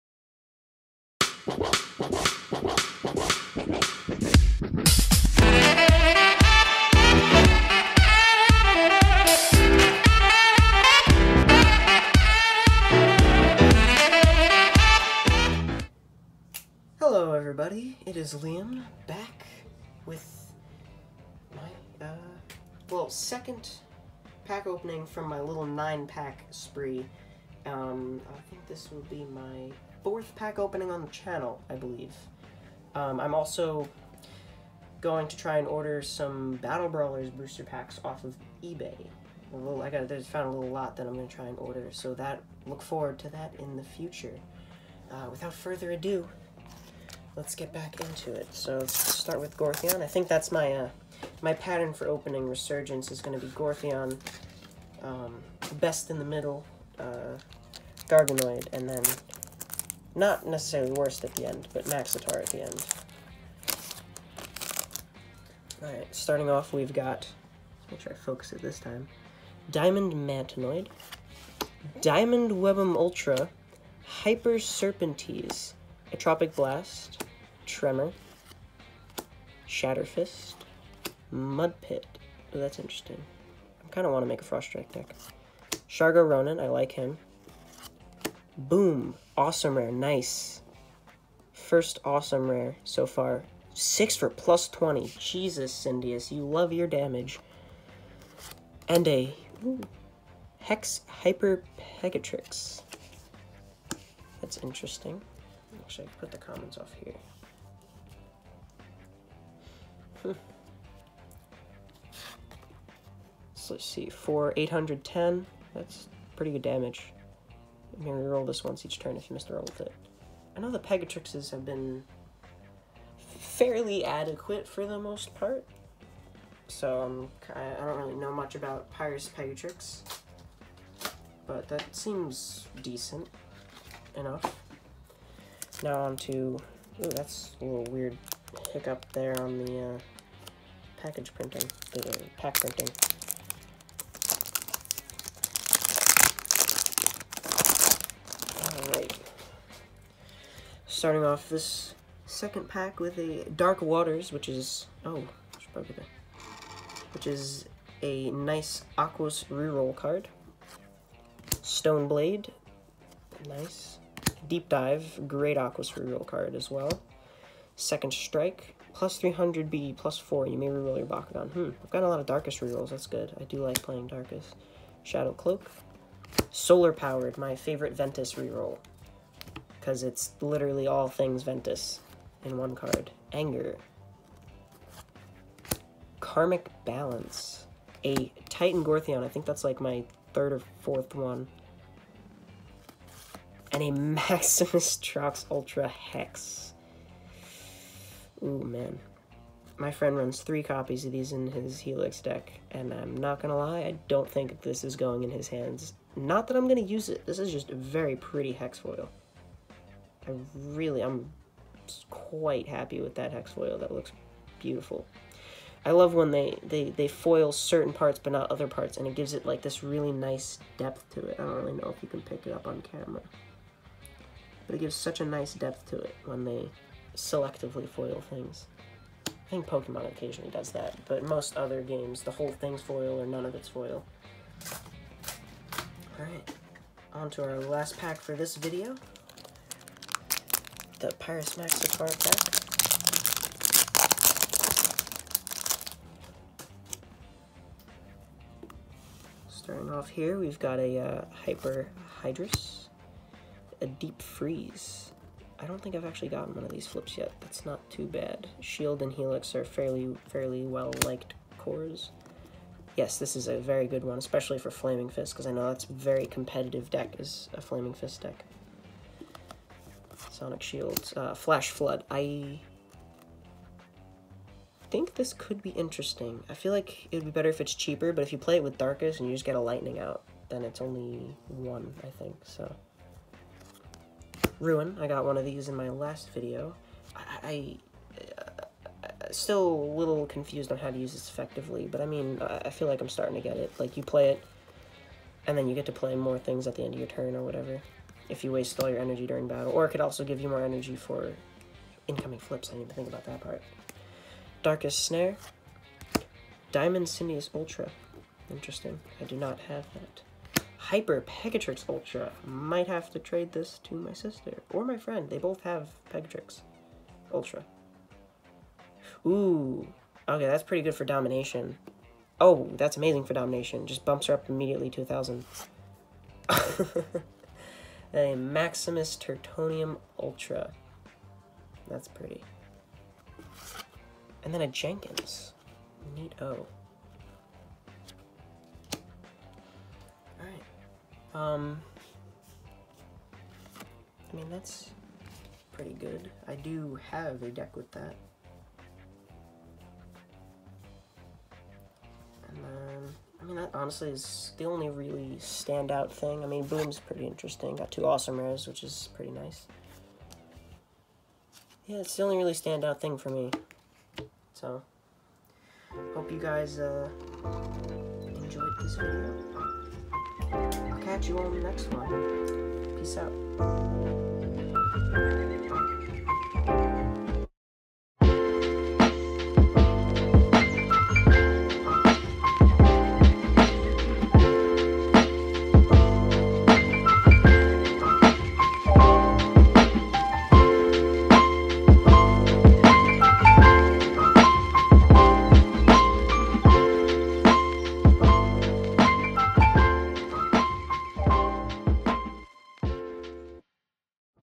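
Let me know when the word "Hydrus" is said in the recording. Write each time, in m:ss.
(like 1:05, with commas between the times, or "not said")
4:12.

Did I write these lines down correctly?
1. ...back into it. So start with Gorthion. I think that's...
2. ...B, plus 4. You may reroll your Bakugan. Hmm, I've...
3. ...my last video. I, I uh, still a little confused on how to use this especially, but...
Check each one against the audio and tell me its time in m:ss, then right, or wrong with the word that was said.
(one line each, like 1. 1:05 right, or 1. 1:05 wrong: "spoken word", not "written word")
1. 0:47 right
2. 2:49 right
3. 4:45 wrong: "effectively", not "especially".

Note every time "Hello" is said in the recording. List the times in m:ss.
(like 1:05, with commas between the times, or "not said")
0:16.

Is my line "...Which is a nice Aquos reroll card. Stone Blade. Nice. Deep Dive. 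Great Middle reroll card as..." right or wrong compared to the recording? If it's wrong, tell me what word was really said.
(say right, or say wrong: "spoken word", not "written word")
wrong: "Aquos", not "Middle".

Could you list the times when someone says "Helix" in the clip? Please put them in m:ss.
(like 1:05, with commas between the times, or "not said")
3:21, 4:19.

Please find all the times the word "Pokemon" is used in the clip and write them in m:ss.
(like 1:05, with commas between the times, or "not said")
3:49.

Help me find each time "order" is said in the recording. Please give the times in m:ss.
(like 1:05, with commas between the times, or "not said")
0:35, 0:41.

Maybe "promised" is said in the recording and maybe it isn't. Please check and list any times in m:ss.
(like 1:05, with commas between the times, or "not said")
not said.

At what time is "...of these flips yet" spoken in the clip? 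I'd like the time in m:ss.
4:16.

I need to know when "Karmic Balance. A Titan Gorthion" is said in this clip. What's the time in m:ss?
3:06.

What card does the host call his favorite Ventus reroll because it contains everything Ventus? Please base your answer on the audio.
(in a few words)
Solar Powered.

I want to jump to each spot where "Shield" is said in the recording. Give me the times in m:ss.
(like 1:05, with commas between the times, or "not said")
4:18, 4:30.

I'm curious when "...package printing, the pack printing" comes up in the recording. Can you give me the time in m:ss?
2:21.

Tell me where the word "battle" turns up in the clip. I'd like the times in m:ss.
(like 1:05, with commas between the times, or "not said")
0:36, 4:59.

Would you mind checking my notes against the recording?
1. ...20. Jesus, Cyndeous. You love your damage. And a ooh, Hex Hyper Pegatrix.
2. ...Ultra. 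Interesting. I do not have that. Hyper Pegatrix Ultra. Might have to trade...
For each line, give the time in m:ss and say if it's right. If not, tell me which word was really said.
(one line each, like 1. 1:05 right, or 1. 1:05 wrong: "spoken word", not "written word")
1. 1:34 right
2. 5:07 right.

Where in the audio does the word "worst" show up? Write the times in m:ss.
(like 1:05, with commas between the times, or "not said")
1:00.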